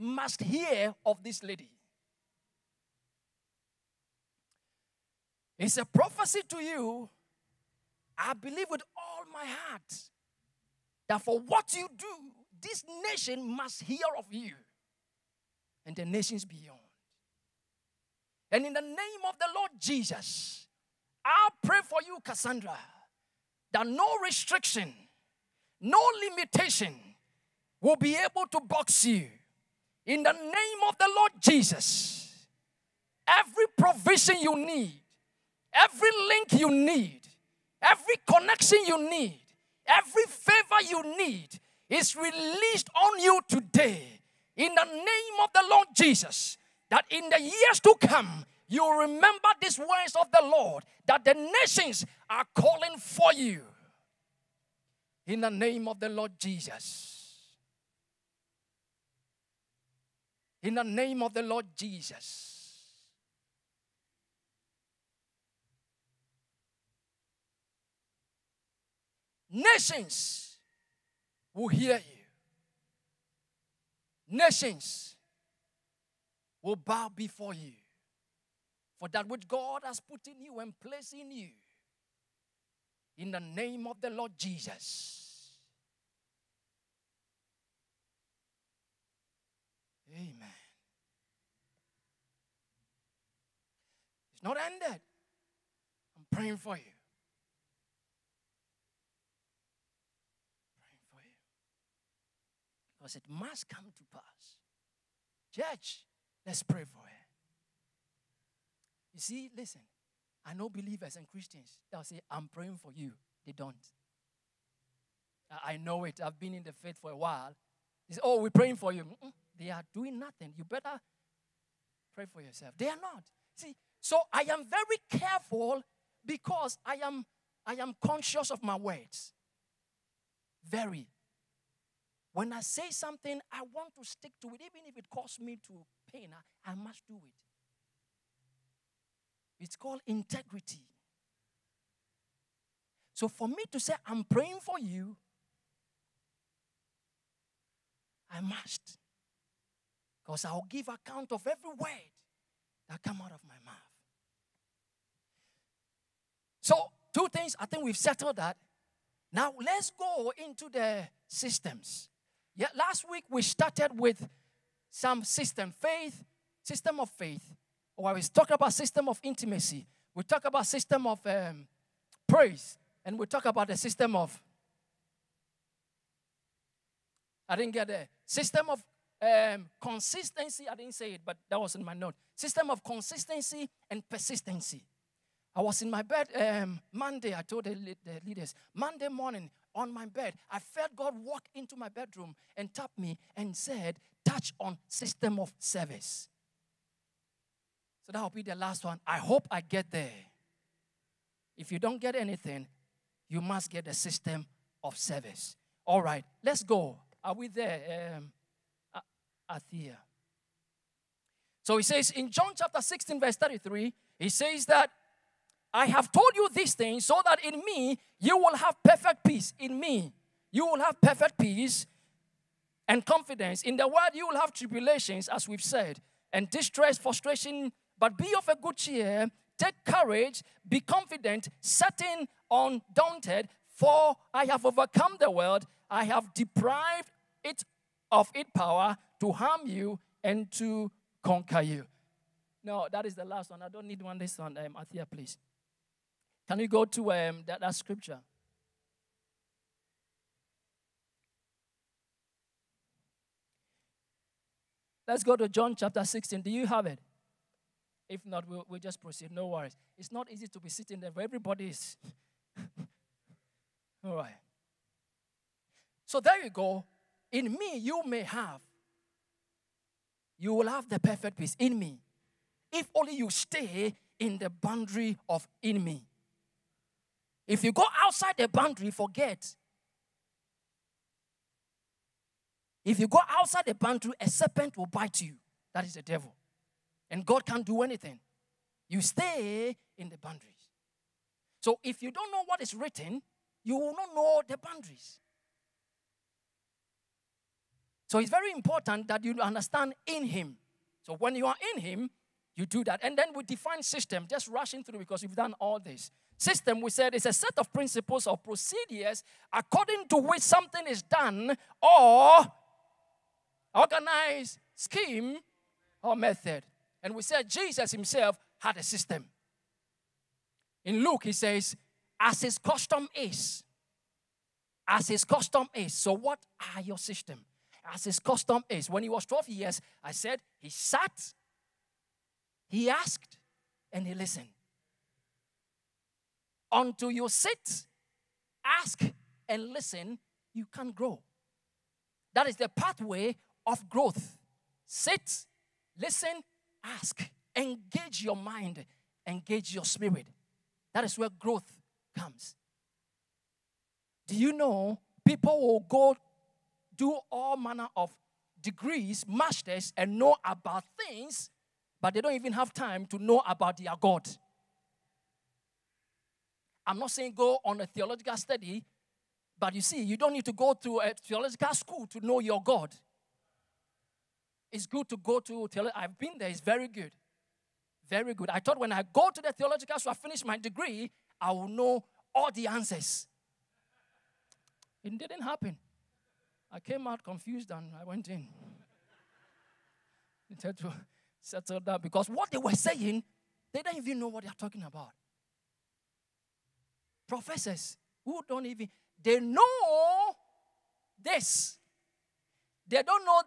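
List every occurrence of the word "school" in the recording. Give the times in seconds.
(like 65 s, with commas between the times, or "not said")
371 s, 379 s.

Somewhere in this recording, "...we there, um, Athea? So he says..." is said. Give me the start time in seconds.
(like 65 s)
207 s.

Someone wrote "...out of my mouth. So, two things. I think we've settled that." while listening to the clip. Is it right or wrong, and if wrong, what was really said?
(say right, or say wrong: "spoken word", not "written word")
right.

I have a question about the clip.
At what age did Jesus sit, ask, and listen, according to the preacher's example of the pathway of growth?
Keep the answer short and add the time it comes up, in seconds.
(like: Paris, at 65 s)
12, at 329 s.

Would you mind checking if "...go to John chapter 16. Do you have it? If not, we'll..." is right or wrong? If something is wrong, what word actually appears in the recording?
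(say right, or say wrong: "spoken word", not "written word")
right.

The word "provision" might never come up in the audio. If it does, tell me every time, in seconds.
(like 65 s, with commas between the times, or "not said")
33 s.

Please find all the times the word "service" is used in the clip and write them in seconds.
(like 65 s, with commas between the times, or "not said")
195 s, 204 s.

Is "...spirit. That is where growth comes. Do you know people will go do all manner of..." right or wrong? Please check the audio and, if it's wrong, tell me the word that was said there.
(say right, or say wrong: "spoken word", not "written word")
right.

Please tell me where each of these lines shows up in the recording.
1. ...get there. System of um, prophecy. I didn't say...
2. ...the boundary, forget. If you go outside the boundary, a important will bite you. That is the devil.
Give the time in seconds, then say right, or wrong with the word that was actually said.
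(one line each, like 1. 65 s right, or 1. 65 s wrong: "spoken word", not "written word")
1. 177 s wrong: "consistency", not "prophecy"
2. 278 s wrong: "serpent", not "important".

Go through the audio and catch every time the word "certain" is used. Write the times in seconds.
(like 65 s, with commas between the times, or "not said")
231 s.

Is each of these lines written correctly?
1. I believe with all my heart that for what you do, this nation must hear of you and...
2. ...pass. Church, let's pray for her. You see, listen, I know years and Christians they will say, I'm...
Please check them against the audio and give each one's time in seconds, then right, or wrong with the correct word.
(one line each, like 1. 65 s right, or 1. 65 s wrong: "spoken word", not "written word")
1. 8 s right
2. 104 s wrong: "believers", not "years".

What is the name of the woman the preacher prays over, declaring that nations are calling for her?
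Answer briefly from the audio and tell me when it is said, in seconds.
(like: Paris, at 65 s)
Cassandra, at 22 s.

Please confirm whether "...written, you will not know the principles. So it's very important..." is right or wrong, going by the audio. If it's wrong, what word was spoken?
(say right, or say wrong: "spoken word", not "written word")
wrong: "boundaries", not "principles".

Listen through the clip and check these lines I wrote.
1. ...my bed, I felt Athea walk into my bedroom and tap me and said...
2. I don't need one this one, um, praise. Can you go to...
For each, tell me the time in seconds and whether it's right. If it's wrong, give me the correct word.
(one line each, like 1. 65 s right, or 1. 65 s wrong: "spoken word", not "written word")
1. 189 s wrong: "God", not "Athea"
2. 243 s wrong: "please", not "praise".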